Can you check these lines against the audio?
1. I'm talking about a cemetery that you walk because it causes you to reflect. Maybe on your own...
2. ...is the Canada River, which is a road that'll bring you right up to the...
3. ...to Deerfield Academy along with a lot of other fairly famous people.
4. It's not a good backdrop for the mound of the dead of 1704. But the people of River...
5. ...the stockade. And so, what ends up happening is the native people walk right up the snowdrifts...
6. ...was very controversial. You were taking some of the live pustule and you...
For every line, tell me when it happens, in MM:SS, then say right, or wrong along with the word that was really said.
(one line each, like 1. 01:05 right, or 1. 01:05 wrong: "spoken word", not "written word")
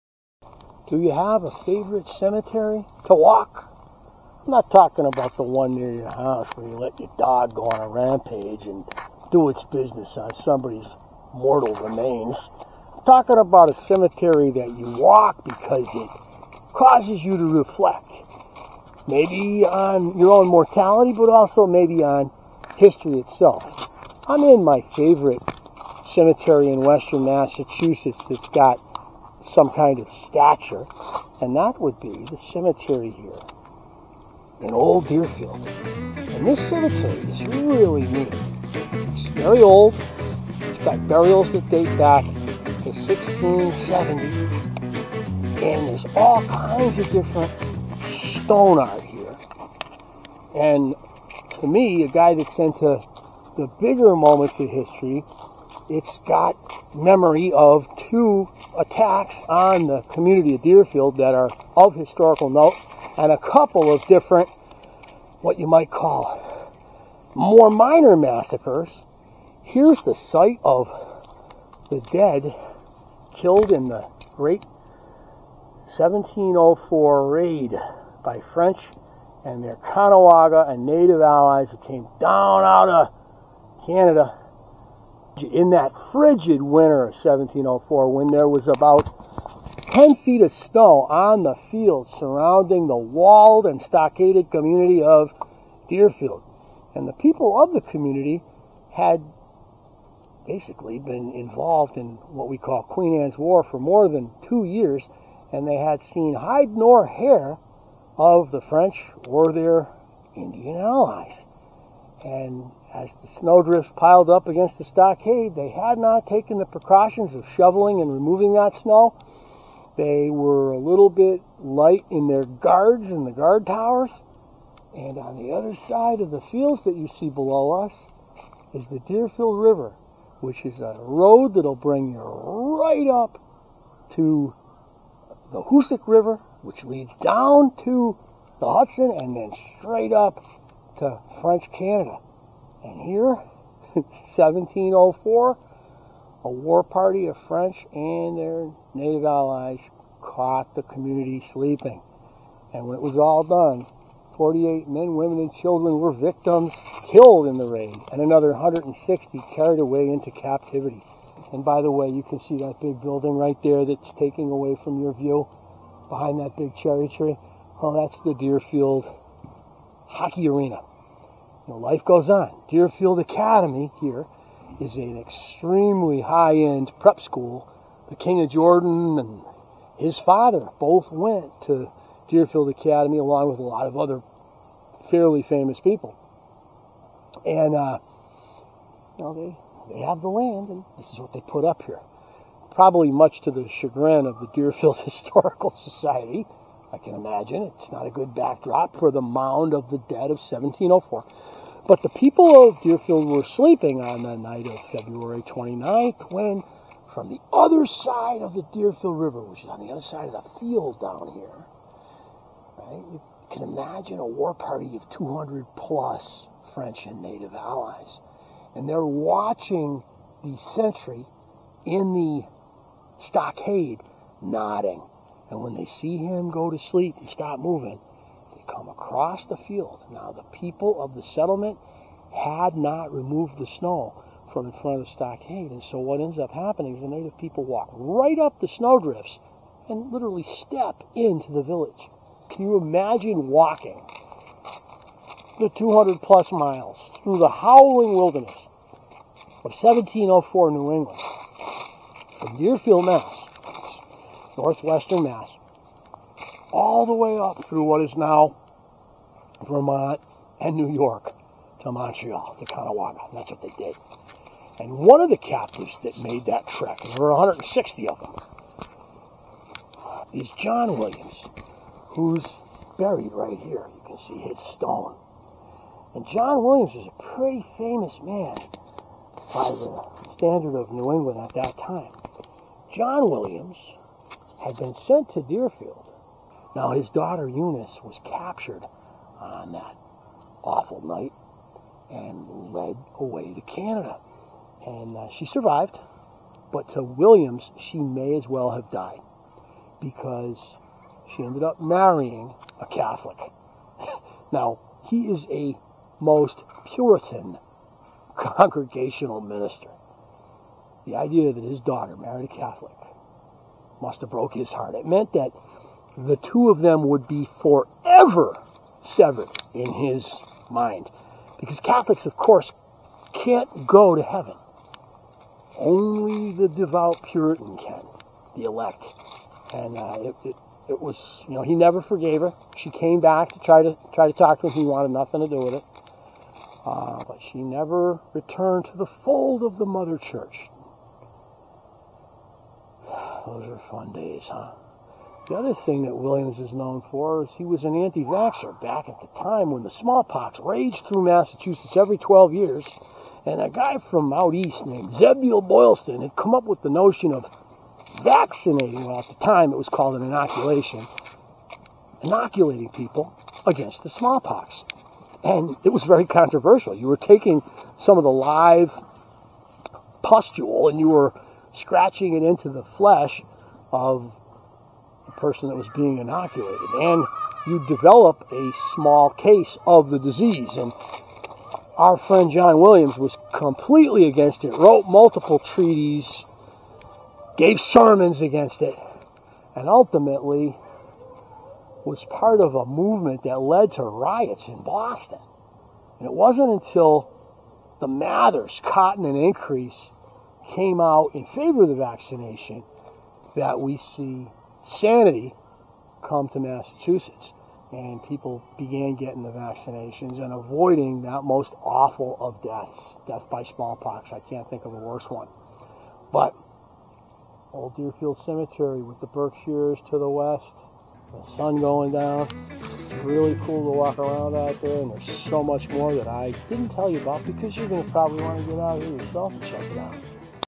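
1. 00:12 right
2. 02:08 wrong: "Deerfield", not "Canada"
3. 03:01 right
4. 03:17 wrong: "Deerfield", not "River"
5. 03:55 right
6. 06:05 right.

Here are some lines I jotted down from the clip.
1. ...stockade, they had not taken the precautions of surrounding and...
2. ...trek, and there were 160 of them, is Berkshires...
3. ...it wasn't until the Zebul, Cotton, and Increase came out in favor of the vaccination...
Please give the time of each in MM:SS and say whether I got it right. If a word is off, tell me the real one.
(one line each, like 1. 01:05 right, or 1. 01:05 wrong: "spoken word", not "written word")
1. 01:54 wrong: "shoveling", not "surrounding"
2. 04:26 wrong: "John", not "Berkshires"
3. 06:36 wrong: "Mathers", not "Zebul".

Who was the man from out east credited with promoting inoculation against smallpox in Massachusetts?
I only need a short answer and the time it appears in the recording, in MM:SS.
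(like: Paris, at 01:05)
Zebul Boylston, at 05:55.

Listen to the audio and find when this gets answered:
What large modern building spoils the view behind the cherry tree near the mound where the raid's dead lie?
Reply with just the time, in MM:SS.
02:48.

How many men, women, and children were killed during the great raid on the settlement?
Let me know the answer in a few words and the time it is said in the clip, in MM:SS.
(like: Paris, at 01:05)
48, at 02:34.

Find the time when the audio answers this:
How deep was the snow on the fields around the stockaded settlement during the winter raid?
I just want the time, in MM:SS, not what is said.
01:29.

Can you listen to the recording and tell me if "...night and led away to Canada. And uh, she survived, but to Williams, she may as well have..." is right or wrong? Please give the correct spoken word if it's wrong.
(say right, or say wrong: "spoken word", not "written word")
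right.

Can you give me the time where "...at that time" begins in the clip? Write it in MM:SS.
04:41.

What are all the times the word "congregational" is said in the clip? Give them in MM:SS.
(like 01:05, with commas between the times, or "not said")
05:08.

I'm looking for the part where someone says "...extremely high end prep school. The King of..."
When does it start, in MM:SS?
02:55.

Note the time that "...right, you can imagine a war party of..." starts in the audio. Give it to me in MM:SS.
03:32.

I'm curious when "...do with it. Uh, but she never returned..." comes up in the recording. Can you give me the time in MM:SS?
05:35.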